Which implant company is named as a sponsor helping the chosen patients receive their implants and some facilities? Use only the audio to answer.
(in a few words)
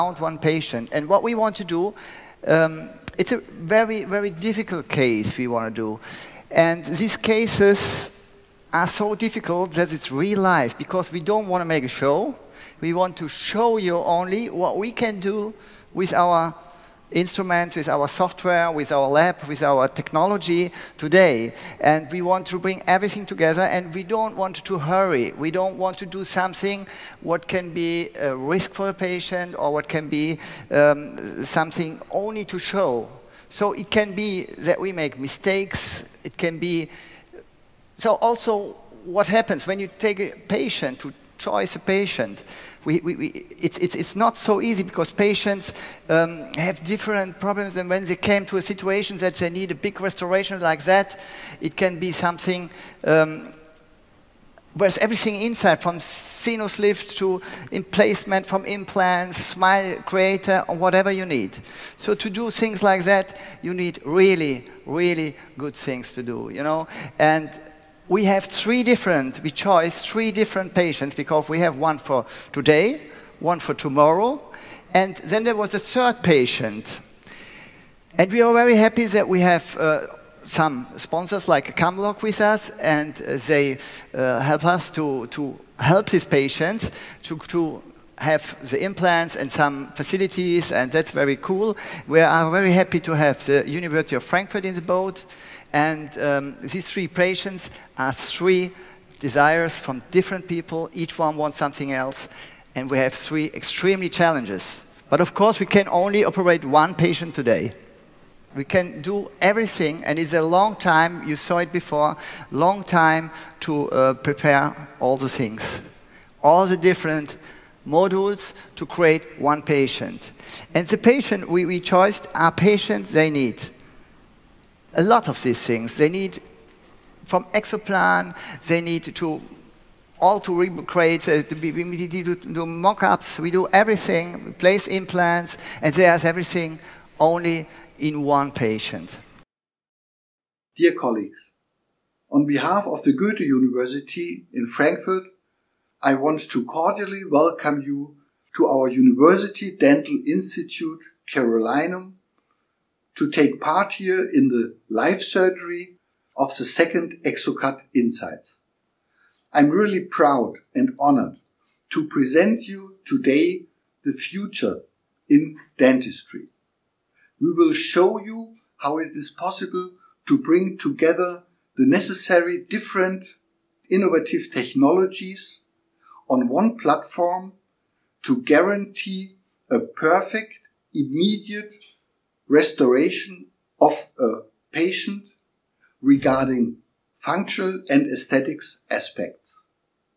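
Camlog.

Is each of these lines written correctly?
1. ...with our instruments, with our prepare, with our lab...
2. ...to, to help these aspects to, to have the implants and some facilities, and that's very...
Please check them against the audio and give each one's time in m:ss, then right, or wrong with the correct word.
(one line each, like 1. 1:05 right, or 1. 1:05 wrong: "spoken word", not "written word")
1. 0:15 wrong: "software", not "prepare"
2. 1:24 wrong: "patients", not "aspects".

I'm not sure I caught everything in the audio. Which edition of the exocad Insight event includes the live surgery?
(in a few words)
second.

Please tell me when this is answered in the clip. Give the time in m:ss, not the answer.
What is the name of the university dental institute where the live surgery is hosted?
2:31.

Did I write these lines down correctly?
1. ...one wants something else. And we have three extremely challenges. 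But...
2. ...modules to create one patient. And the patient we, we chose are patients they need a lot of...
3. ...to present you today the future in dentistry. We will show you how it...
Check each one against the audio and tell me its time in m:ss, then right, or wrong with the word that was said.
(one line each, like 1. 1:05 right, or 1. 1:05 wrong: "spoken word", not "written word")
1. 1:41 right
2. 1:57 right
3. 2:41 right.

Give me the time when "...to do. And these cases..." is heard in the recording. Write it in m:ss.
0:05.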